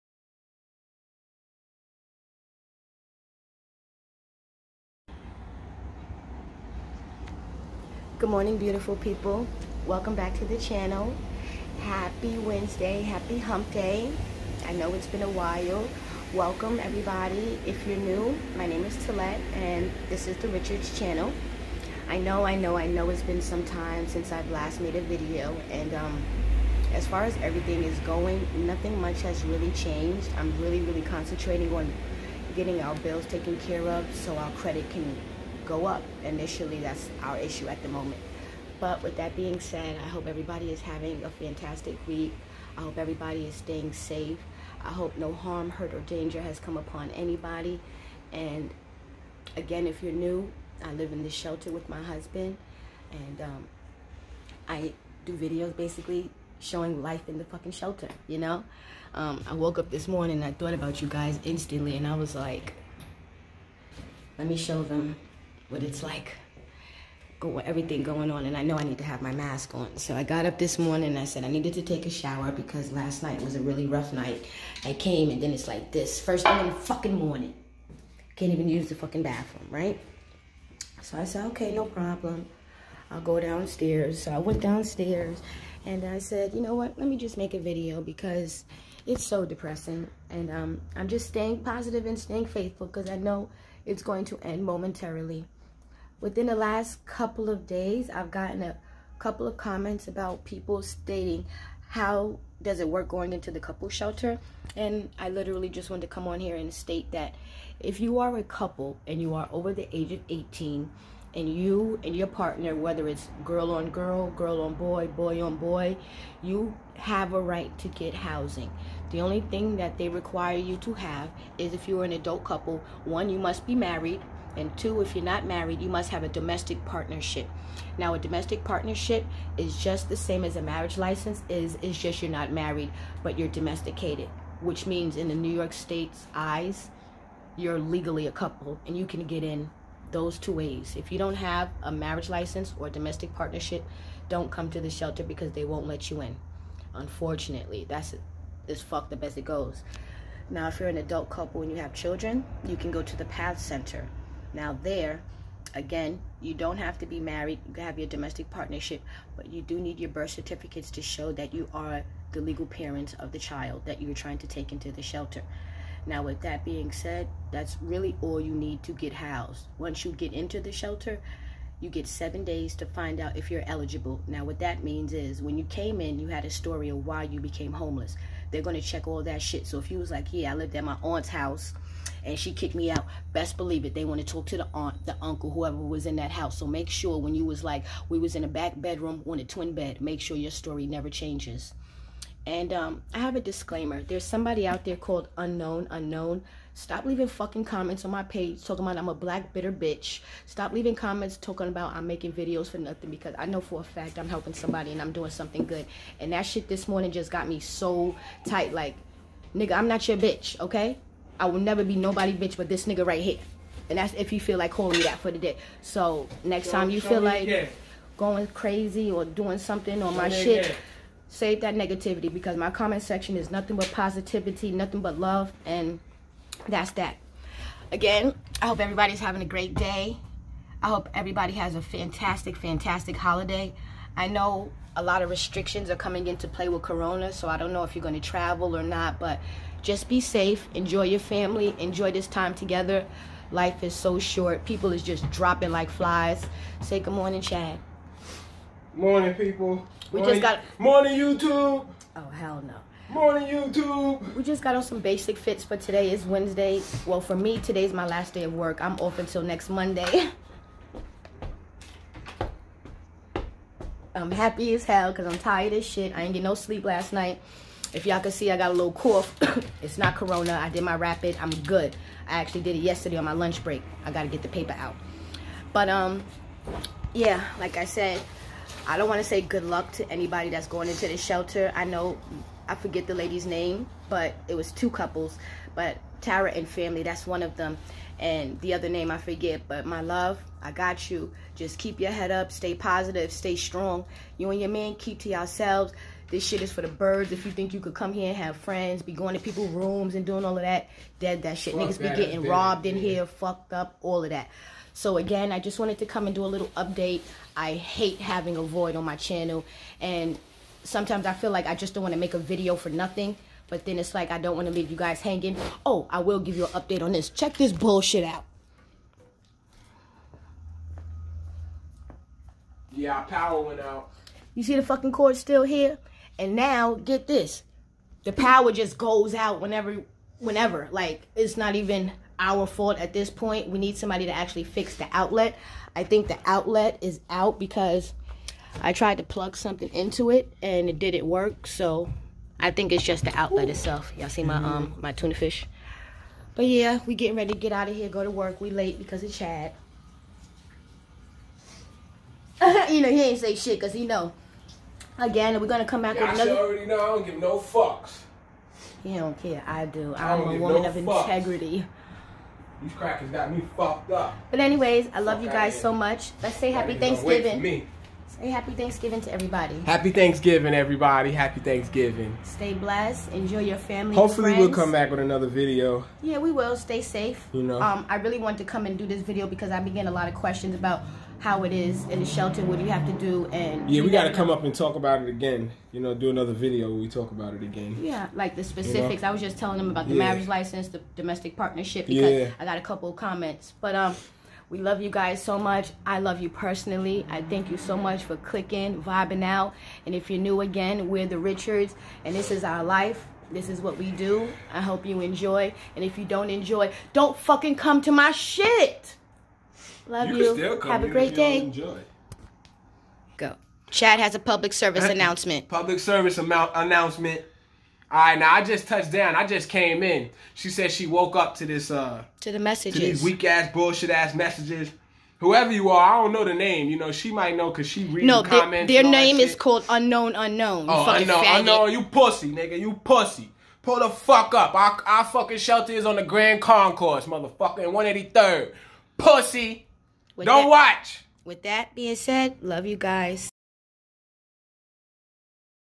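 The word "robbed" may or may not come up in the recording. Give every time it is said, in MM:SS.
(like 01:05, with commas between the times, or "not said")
05:02.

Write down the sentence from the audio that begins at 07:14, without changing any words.
Our, our fucking shelter is on the Grand Concourse, motherfucker, in 183rd.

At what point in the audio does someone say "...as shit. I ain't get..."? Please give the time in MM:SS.
04:25.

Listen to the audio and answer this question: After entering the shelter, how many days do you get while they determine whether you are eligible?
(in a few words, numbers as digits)
7 days.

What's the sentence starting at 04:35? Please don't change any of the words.
But, um, yeah, like I said, I don't want to say good luck to anybody that's going into the shelter.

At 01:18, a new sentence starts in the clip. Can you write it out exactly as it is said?
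Can't even use the fucking bathroom, right?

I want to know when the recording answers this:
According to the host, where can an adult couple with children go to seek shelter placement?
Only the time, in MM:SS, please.
02:33.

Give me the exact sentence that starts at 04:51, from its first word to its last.
Just keep your head up, stay positive, stay strong.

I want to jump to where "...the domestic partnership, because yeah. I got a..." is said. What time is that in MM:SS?
06:30.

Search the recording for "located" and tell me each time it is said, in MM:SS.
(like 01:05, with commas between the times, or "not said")
not said.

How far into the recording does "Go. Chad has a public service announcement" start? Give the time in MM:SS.
06:53.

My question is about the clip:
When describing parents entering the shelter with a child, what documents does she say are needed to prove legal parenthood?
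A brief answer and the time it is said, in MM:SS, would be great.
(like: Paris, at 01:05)
birth certificates, at 02:40.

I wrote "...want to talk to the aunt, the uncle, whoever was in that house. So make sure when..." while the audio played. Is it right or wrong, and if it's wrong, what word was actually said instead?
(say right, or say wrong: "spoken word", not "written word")
right.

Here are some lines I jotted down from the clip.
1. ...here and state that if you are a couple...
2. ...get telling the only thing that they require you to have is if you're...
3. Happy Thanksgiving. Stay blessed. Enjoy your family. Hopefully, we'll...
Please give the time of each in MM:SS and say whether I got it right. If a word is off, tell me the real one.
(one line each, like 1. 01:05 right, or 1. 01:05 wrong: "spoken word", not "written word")
1. 01:46 right
2. 01:57 wrong: "housing", not "telling"
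3. 06:11 right.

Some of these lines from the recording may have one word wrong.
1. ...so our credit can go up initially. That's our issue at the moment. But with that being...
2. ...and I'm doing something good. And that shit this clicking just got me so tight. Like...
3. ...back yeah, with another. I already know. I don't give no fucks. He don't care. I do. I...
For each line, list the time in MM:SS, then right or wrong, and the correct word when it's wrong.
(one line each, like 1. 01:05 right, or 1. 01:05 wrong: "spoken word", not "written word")
1. 00:34 right
2. 03:24 wrong: "morning", not "clicking"
3. 05:56 right.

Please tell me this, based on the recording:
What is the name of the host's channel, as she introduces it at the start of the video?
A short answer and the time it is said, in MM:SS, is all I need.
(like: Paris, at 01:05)
the Richards channel, at 00:20.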